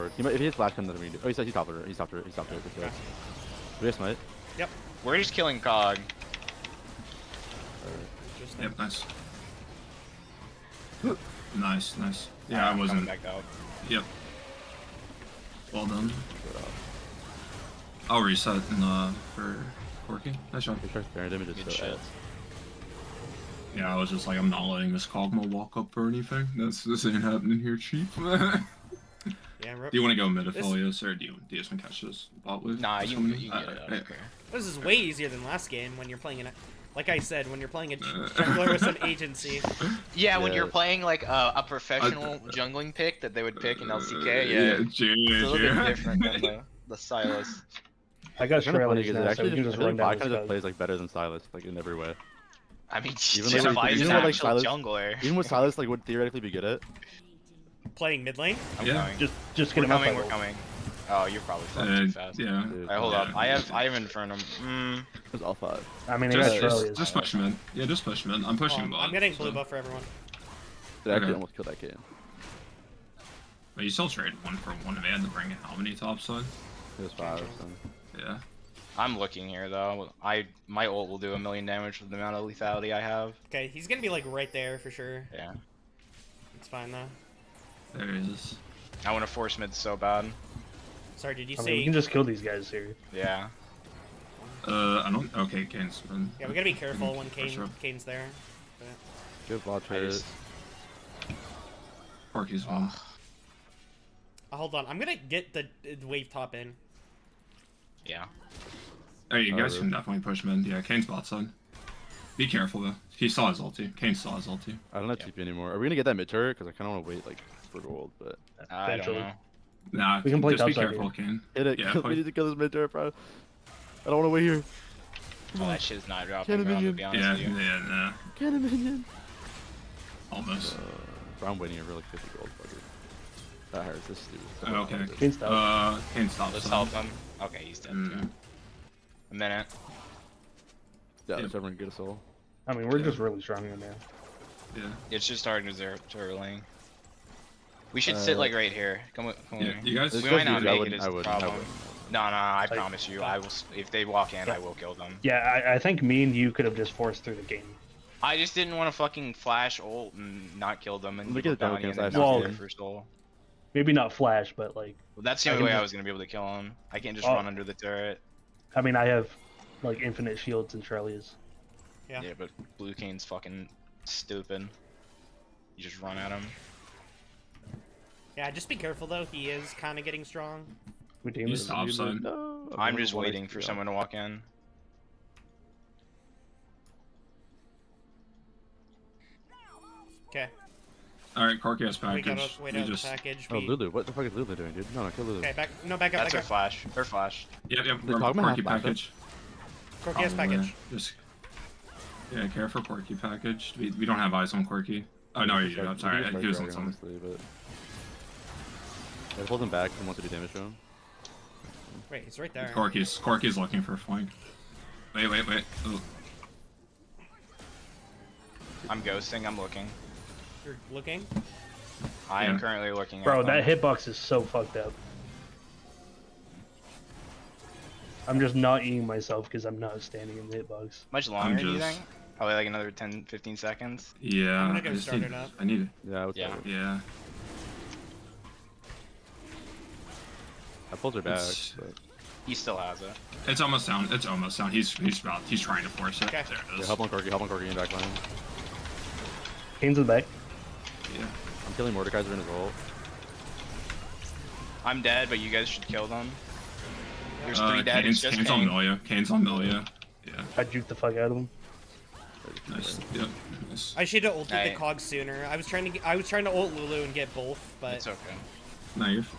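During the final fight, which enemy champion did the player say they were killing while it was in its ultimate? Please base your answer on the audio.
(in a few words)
Mordekaiser.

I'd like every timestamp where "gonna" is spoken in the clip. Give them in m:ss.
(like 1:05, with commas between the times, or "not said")
1:23, 1:44, 1:55, 2:45, 3:54.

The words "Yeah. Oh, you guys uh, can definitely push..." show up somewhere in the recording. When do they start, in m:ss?
1:48.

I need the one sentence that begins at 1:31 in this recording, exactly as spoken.
Mean, we can just kill these guys here.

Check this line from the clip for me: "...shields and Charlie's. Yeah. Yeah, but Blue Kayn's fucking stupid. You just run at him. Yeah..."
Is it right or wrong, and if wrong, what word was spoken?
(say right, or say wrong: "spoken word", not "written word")
right.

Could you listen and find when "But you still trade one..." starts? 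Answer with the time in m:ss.
1:13.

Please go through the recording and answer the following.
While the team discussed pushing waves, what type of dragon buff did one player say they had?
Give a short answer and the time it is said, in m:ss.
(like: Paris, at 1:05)
Inferno, at 1:03.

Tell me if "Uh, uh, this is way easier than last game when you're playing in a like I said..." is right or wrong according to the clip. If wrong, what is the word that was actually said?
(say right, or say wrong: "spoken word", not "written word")
right.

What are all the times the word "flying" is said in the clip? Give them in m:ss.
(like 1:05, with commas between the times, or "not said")
1:01.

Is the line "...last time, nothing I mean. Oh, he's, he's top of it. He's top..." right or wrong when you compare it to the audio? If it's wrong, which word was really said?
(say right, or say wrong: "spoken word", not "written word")
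right.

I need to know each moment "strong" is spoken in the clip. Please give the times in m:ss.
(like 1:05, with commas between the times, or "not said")
2:23, 3:00.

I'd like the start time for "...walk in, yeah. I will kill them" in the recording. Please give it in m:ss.
2:34.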